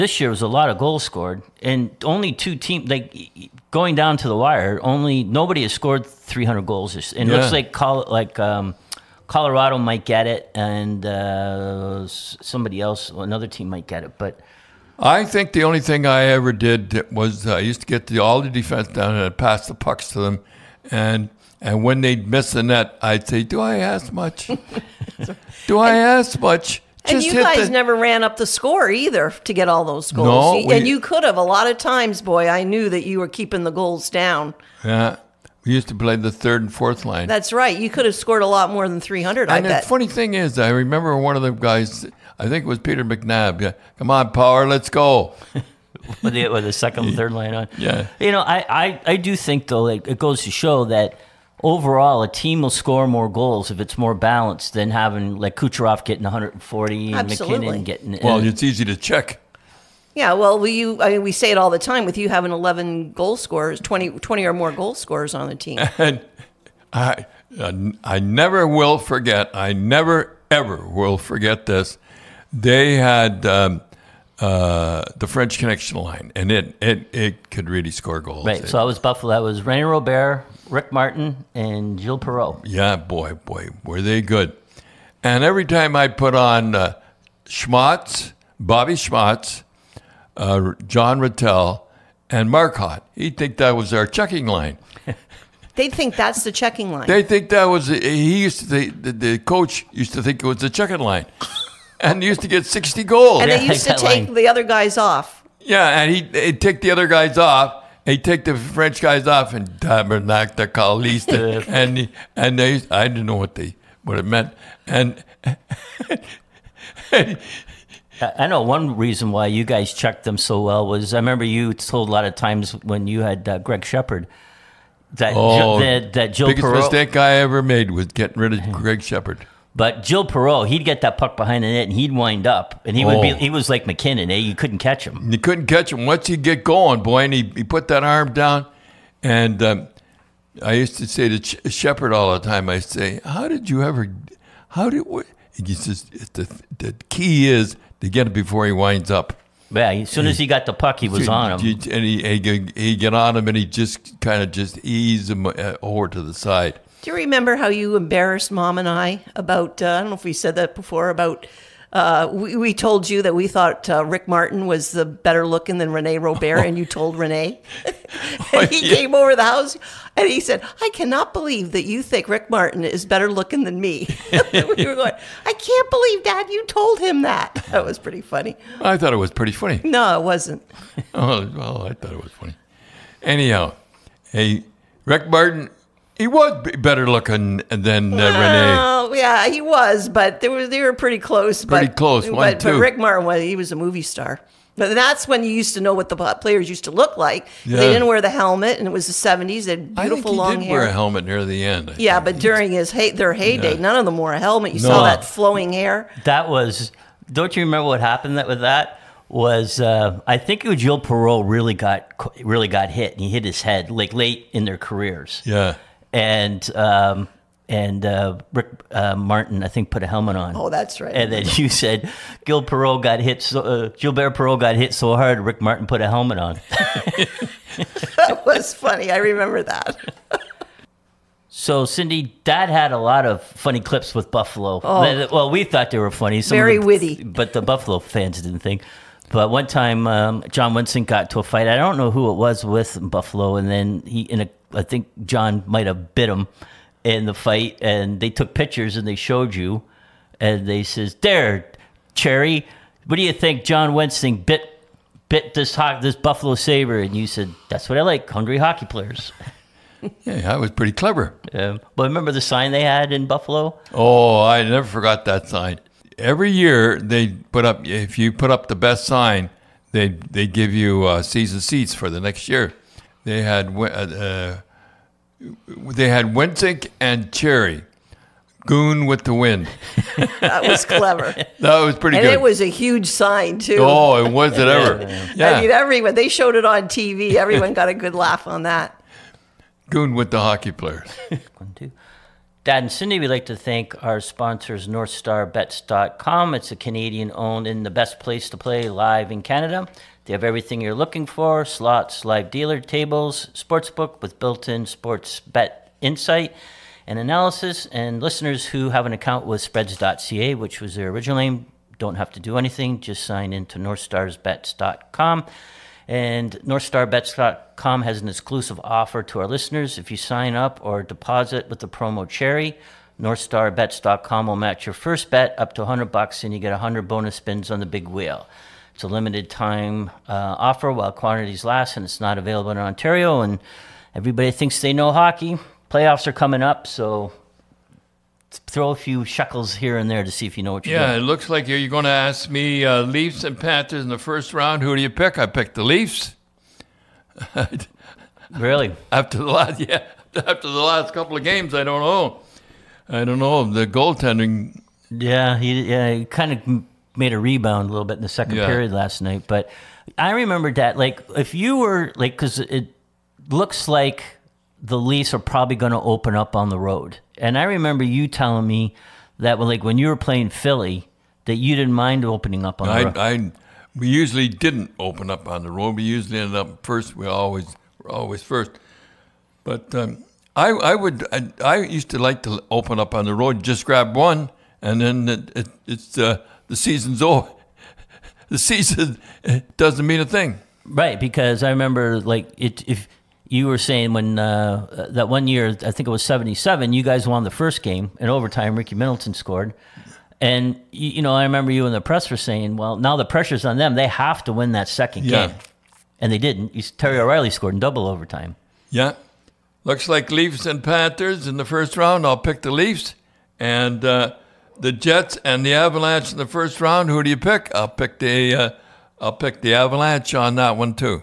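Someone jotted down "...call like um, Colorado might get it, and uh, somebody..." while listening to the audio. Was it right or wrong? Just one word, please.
right.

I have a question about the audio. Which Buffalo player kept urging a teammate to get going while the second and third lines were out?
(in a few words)
Peter McNab.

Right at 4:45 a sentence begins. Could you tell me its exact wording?
I mean everyone they showed it on TV.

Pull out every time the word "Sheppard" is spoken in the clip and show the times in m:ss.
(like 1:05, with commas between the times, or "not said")
2:03, 2:09, 2:21.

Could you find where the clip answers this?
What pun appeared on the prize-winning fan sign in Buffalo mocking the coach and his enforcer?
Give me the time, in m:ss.
4:38.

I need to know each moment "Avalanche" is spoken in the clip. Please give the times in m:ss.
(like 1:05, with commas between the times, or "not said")
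6:55, 6:59.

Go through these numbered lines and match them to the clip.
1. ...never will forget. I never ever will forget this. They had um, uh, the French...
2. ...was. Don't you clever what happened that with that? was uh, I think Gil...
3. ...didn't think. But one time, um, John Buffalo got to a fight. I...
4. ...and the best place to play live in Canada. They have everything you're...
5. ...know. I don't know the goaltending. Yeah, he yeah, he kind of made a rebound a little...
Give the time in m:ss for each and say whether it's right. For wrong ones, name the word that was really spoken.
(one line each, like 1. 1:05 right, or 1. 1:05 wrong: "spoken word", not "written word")
1. 1:08 right
2. 3:26 wrong: "remember", not "clever"
3. 3:58 wrong: "Wensink", not "Buffalo"
4. 4:57 right
5. 5:52 right.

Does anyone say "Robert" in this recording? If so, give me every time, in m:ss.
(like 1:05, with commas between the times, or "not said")
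1:19, 2:46.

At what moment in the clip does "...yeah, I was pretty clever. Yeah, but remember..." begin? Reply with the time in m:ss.
4:20.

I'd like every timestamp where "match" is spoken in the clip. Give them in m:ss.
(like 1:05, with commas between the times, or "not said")
5:24.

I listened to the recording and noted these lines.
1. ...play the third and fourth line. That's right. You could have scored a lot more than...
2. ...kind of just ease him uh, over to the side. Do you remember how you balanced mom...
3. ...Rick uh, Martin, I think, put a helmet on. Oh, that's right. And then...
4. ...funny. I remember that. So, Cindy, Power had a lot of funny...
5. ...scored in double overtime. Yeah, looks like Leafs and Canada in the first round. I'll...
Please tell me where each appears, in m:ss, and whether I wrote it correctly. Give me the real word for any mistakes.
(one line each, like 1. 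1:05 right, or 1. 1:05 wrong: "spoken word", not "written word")
1. 0:35 right
2. 2:34 wrong: "embarrassed", not "balanced"
3. 3:38 right
4. 3:48 wrong: "Dad", not "Power"
5. 6:47 wrong: "Panthers", not "Canada".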